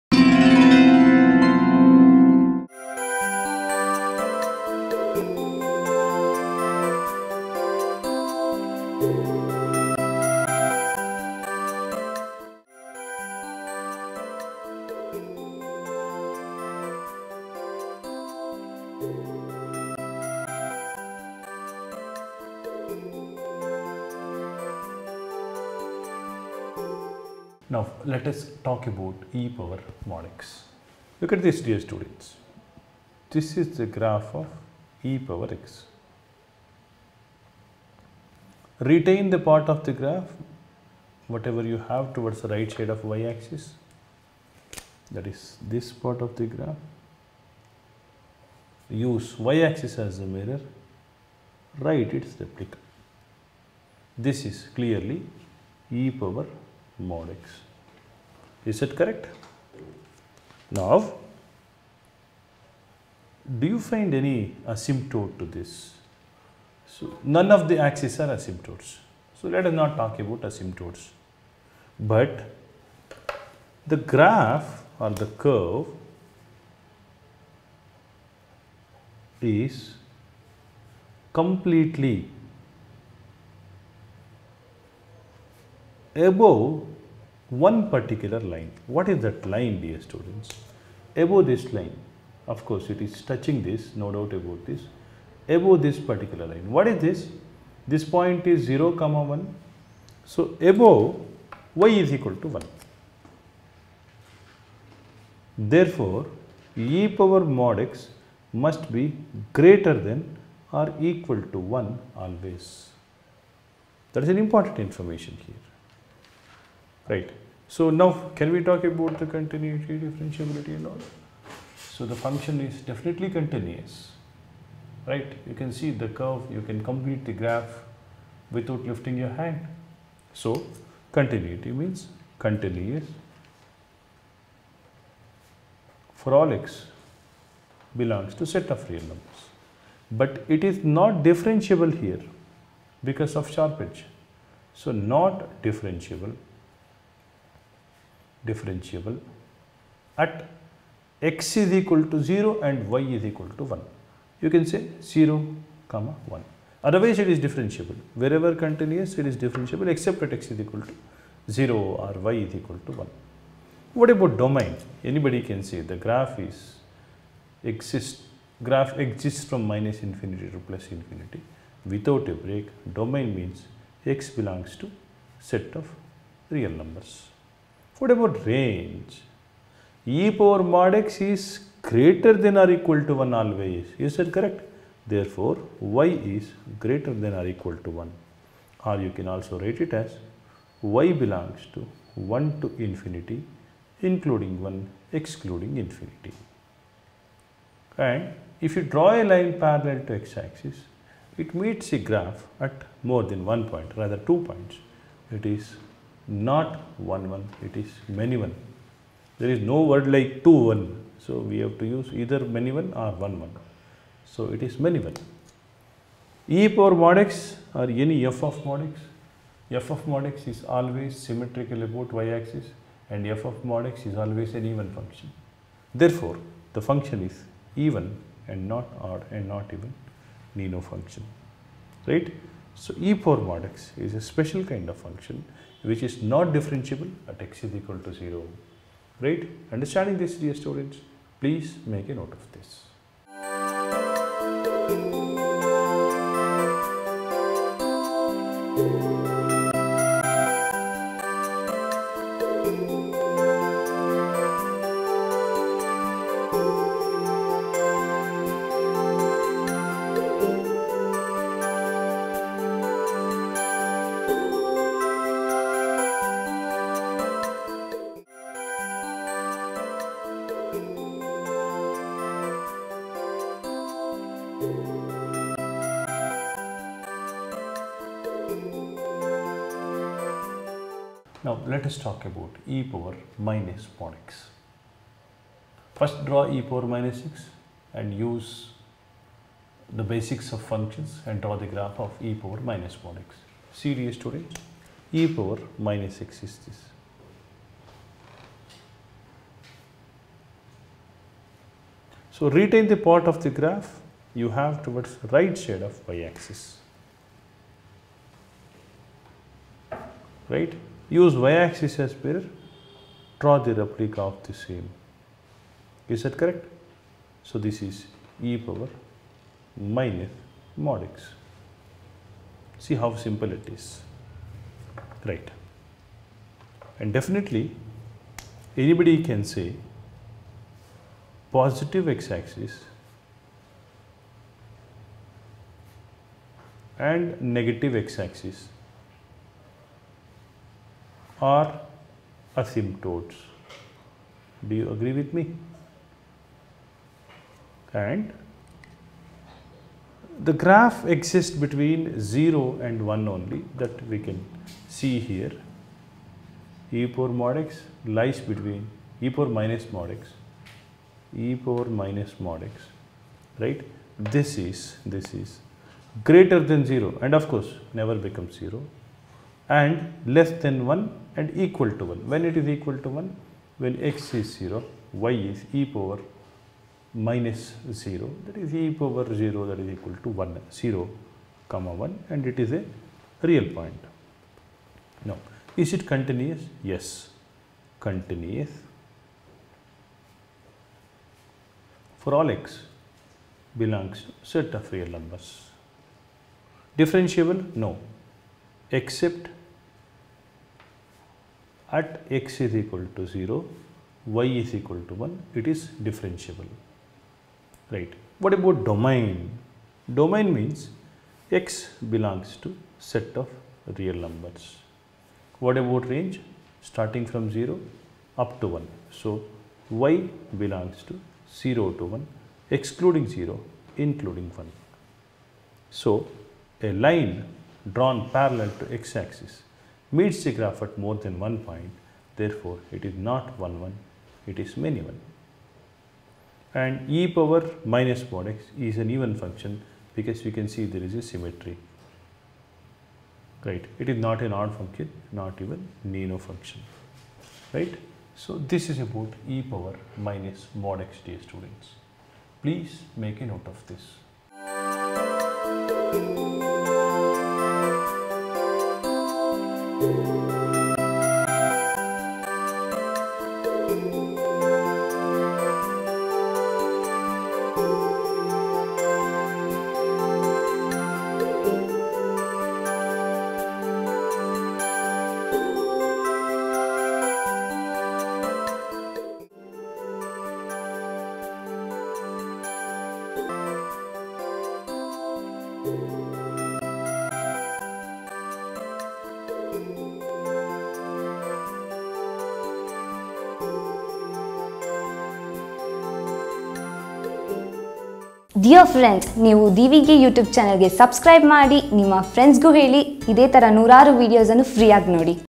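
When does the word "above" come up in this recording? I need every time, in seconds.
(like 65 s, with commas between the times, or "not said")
86 s, 91 s, 95 s, 100 s.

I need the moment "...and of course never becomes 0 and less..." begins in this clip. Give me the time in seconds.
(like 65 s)
367 s.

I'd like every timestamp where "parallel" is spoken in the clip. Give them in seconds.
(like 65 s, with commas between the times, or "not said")
199 s, 428 s.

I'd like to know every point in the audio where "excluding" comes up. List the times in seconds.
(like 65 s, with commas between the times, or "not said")
195 s, 422 s.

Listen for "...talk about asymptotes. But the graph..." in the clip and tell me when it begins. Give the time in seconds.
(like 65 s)
69 s.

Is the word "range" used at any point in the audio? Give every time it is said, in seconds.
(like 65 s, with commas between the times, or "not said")
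178 s, 416 s.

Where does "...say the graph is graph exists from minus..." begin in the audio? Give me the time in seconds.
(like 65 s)
165 s.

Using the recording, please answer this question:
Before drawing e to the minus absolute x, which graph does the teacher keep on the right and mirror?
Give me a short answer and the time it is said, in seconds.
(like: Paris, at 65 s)
e power minus x, at 295 s.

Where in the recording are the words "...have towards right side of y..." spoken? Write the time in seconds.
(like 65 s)
304 s.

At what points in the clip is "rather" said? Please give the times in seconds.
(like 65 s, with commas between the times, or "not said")
203 s.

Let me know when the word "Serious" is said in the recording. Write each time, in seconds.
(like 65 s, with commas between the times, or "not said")
293 s.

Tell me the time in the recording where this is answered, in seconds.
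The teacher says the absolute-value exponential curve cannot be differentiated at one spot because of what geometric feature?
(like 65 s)
143 s.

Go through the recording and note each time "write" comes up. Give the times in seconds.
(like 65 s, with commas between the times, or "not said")
51 s, 189 s.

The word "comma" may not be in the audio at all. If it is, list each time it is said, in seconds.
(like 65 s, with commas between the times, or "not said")
98 s, 155 s, 381 s.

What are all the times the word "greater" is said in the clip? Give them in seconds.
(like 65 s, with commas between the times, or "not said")
109 s, 181 s, 186 s, 366 s.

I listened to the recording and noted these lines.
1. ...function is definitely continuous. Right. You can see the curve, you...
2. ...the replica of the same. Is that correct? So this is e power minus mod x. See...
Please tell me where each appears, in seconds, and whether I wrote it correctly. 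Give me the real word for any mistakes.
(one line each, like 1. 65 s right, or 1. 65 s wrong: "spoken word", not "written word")
1. 122 s right
2. 313 s right.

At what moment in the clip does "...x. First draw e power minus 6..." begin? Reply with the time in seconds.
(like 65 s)
284 s.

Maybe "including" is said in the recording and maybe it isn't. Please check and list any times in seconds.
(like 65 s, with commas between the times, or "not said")
194 s, 423 s.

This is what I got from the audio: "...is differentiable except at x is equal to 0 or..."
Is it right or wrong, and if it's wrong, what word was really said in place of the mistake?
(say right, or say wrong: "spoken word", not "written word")
right.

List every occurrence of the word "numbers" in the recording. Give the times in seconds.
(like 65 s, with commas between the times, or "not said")
139 s, 176 s, 395 s, 414 s.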